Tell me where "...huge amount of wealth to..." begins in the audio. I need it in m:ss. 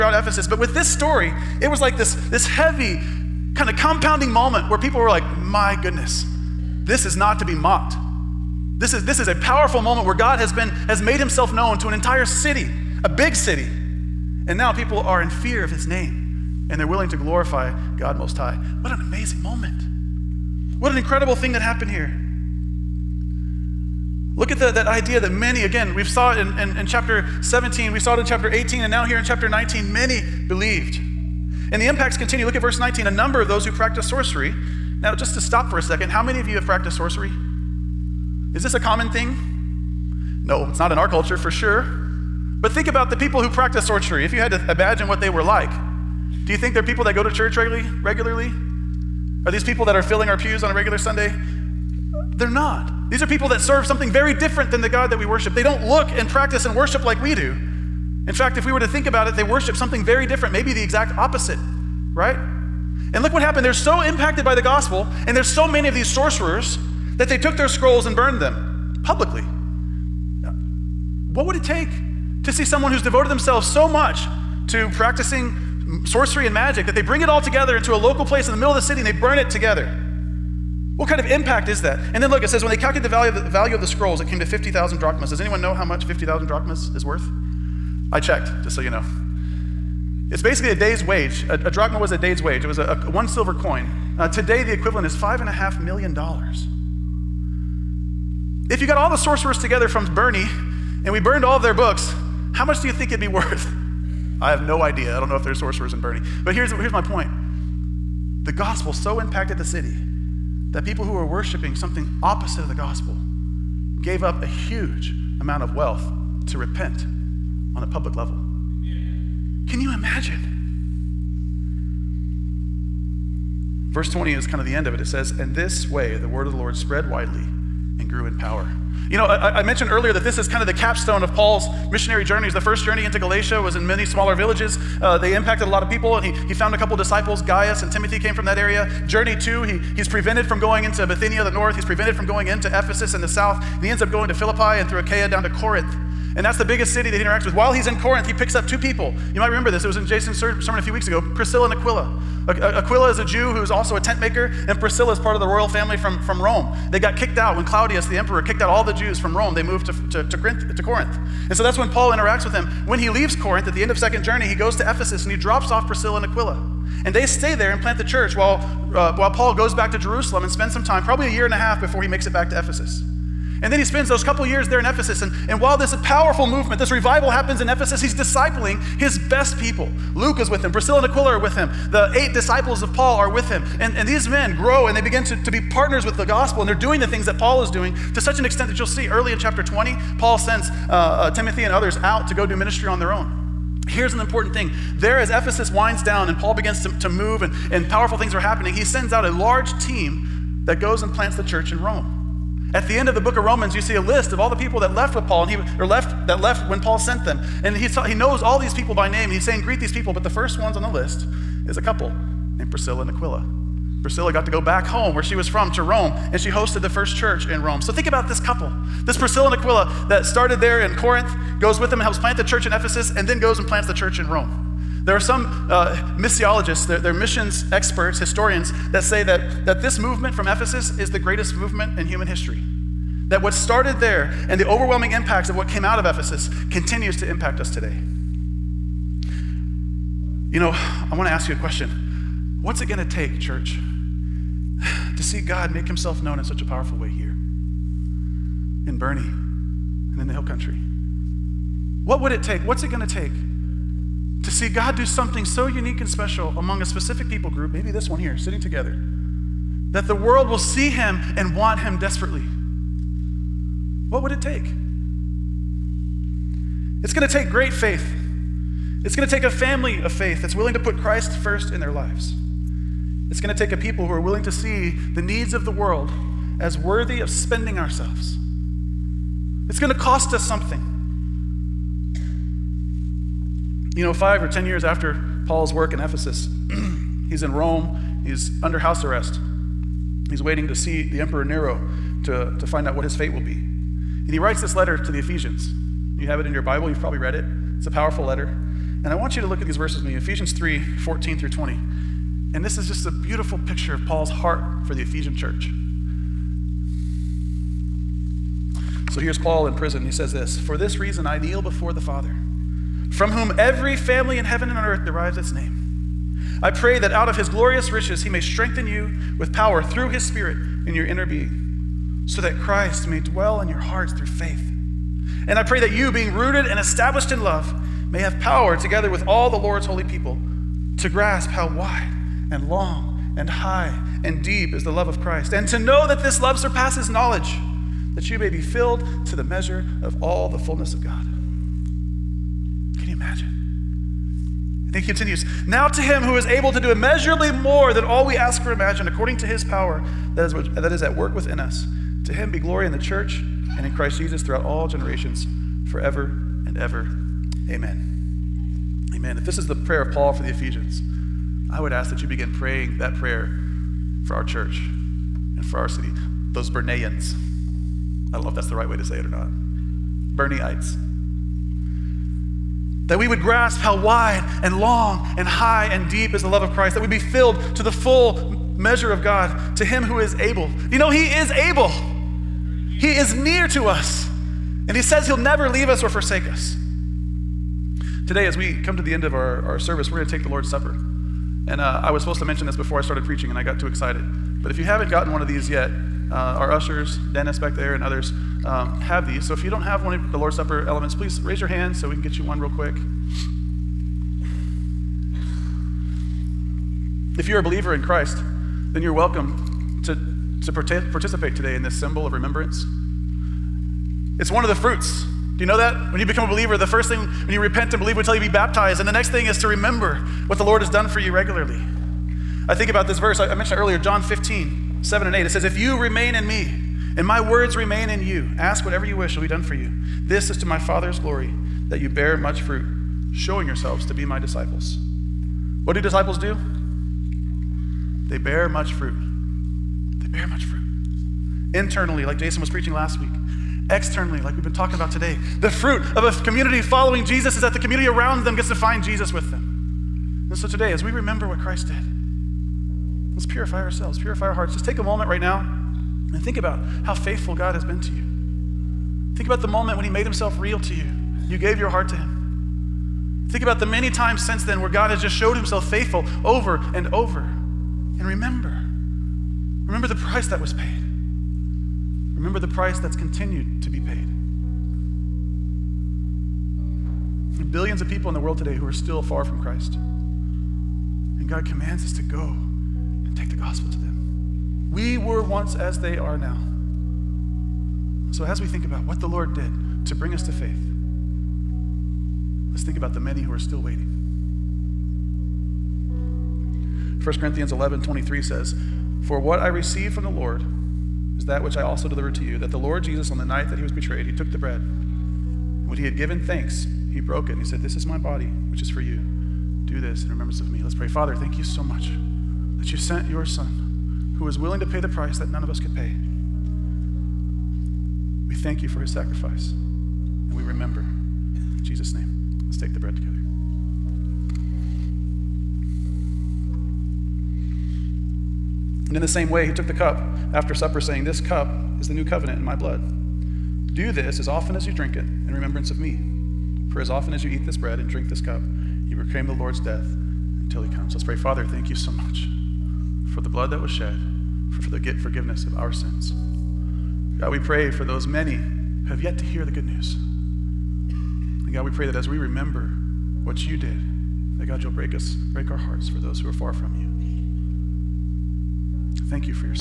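1:54.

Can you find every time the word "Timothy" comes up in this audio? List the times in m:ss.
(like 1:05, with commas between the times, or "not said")
2:17, 3:11.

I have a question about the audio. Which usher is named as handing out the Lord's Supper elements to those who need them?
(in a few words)
Dennis.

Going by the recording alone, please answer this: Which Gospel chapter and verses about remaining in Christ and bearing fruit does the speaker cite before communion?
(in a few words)
John 15:7-8.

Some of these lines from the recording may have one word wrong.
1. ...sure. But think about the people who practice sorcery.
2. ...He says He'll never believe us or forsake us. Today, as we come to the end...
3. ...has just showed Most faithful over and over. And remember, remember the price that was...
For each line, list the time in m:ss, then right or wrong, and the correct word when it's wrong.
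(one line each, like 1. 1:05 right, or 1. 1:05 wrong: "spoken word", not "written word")
1. 0:41 right
2. 6:24 wrong: "leave", not "believe"
3. 7:45 wrong: "Himself", not "Most".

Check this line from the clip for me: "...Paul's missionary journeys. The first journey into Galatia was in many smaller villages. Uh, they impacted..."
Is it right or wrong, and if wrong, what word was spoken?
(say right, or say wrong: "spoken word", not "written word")
right.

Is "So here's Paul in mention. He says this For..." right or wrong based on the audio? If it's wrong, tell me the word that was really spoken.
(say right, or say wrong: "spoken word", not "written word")
wrong: "prison", not "mention".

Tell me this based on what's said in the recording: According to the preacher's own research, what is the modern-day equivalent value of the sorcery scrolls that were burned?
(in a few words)
$5.5 million.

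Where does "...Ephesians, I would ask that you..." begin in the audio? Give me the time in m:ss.
6:00.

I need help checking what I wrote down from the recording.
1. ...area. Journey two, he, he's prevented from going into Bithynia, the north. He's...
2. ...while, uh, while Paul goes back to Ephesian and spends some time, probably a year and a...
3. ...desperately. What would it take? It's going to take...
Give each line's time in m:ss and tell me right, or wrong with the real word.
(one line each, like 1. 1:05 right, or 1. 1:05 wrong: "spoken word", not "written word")
1. 2:18 right
2. 2:48 wrong: "Jerusalem", not "Ephesian"
3. 4:21 right.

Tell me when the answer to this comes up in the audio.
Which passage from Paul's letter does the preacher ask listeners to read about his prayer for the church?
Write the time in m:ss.
5:00.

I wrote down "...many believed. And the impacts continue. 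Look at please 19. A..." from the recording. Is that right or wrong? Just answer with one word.
wrong.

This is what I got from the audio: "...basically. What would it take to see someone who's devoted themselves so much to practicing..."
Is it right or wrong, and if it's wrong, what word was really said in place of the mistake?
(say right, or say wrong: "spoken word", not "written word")
wrong: "publicly", not "basically".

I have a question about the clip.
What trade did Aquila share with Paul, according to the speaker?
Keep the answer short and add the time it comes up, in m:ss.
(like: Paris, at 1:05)
Tent maker, at 2:33.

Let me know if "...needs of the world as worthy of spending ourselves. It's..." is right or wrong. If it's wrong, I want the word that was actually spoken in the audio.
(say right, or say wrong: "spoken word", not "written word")
right.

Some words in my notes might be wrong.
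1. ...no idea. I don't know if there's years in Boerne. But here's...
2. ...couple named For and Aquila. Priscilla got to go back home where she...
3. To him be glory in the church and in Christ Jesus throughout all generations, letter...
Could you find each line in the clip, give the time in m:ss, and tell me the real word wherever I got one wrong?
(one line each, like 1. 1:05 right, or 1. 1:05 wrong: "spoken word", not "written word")
1. 1:44 wrong: "sorcerers", not "years"
2. 3:31 wrong: "Priscilla", not "For"
3. 5:52 wrong: "forever", not "letter".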